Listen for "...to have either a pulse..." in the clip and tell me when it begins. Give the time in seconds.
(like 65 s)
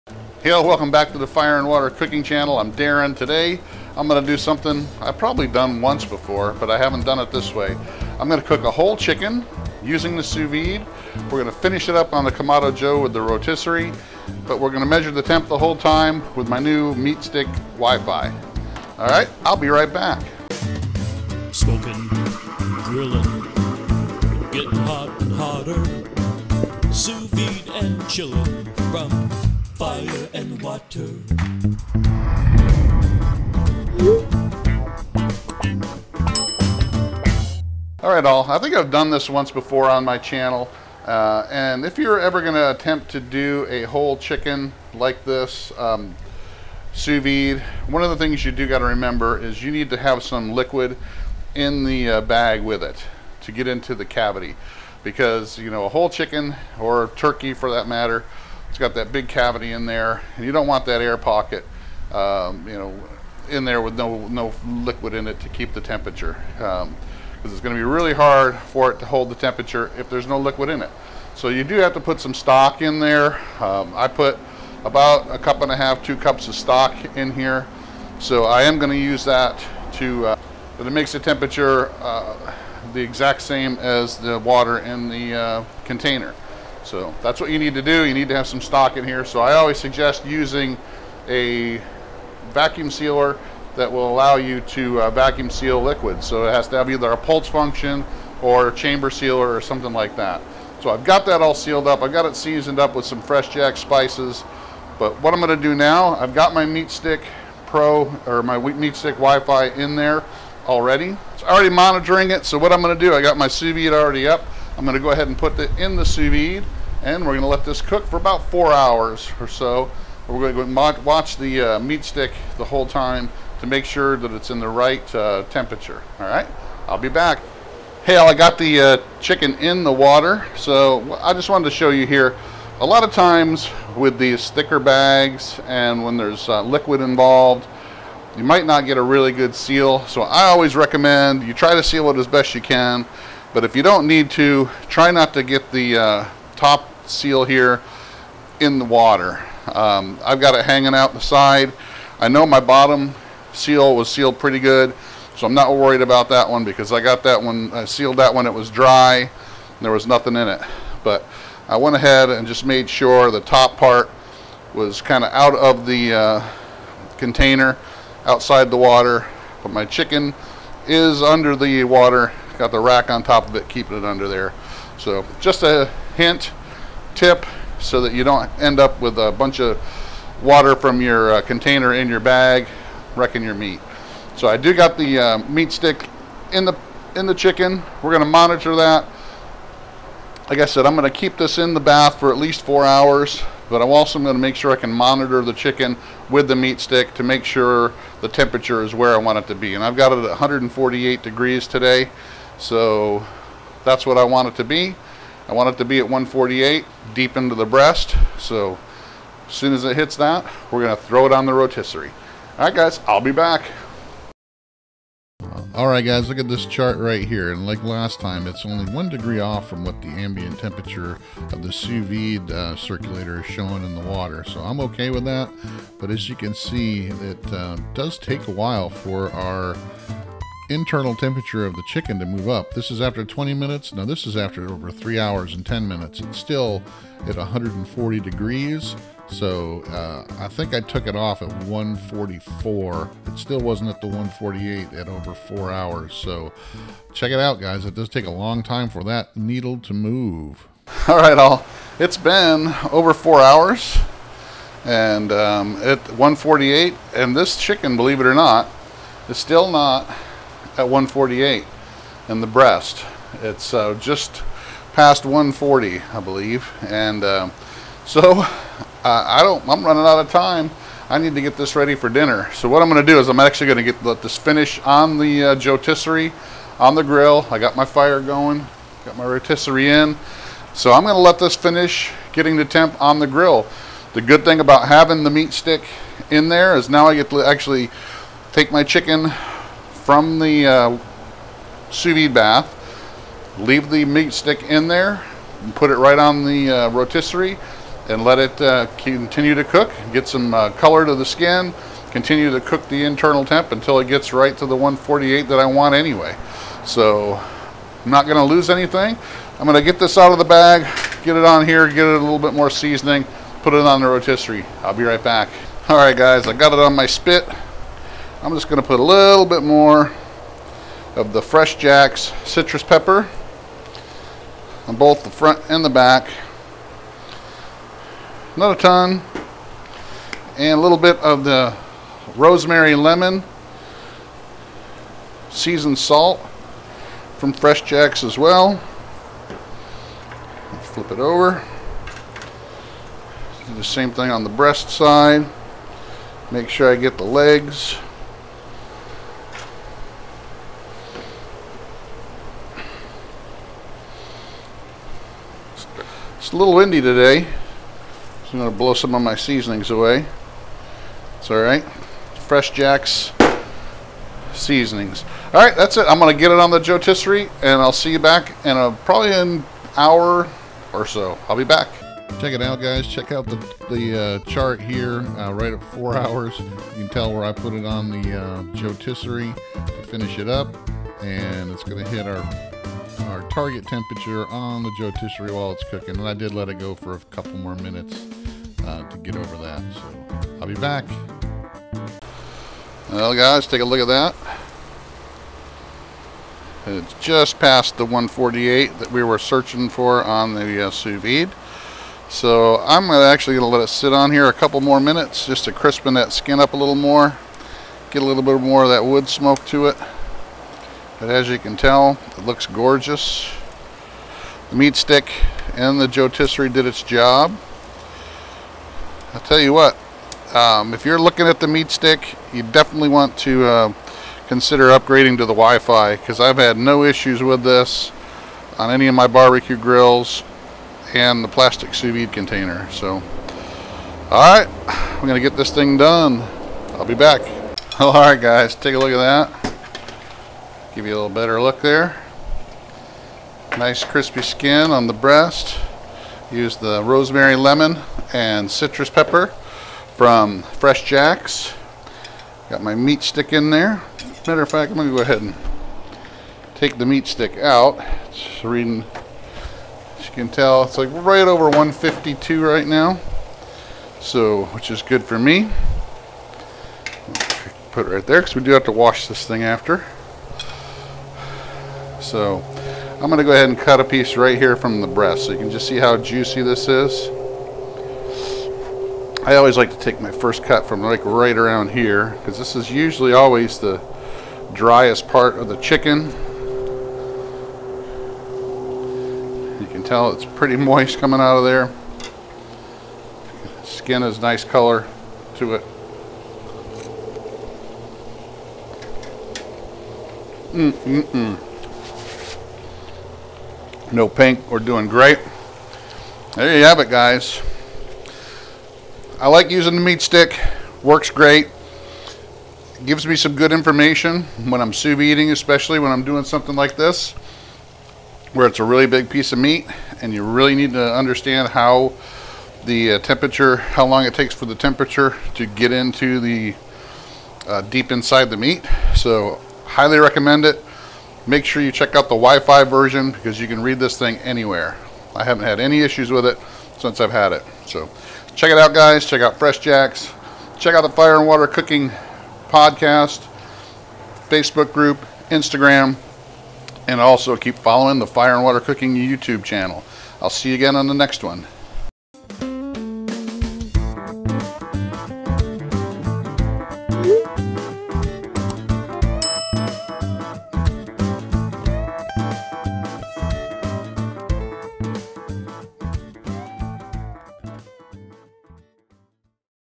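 96 s.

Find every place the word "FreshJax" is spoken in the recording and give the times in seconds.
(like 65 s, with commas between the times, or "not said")
103 s, 321 s, 337 s, 362 s, 450 s, 539 s.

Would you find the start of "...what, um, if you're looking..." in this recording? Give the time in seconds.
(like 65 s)
419 s.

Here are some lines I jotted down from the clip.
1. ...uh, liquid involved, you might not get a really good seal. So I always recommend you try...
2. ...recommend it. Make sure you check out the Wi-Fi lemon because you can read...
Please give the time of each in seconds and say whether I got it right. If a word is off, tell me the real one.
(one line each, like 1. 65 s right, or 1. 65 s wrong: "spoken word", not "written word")
1. 136 s right
2. 530 s wrong: "version", not "lemon".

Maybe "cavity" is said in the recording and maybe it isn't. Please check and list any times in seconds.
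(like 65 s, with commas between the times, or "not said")
54 s, 59 s.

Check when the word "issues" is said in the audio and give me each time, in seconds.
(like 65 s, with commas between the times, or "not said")
427 s, 536 s.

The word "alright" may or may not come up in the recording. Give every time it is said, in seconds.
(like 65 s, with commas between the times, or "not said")
361 s, 365 s.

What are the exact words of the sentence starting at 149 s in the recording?
Um, I've got it hanging out the side.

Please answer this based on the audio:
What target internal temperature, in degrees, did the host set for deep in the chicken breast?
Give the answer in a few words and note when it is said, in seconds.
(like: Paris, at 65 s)
148, at 200 s.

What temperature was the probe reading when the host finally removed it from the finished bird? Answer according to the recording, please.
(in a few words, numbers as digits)
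152.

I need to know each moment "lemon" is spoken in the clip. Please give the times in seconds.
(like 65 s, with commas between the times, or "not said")
332 s, 447 s.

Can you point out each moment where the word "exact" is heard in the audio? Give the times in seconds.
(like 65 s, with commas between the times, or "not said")
83 s.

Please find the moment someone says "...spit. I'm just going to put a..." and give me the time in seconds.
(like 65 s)
317 s.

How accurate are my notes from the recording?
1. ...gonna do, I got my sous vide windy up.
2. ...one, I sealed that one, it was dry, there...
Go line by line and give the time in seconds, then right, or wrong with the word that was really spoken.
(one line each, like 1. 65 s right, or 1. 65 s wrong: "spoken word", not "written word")
1. 112 s wrong: "already", not "windy"
2. 157 s right.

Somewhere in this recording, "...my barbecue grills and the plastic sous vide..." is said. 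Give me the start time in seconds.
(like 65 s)
429 s.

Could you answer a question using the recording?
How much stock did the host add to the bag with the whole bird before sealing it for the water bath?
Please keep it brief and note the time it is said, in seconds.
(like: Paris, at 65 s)
1.5 to 2 cups, at 75 s.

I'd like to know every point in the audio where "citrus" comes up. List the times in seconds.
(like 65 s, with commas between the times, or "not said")
322 s, 448 s.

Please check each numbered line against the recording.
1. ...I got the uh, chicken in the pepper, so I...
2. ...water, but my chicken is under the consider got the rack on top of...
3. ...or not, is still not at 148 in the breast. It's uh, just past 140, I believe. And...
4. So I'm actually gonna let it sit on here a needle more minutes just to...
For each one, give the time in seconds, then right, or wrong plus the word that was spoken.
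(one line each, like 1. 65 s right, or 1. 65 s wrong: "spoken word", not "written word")
1. 128 s wrong: "water", not "pepper"
2. 168 s wrong: "water", not "consider"
3. 258 s right
4. 402 s wrong: "couple", not "needle".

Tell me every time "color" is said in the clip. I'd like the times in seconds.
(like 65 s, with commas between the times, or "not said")
300 s, 494 s.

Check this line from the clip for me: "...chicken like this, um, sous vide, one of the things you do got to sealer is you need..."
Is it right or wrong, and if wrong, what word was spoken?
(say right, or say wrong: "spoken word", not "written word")
wrong: "remember", not "sealer".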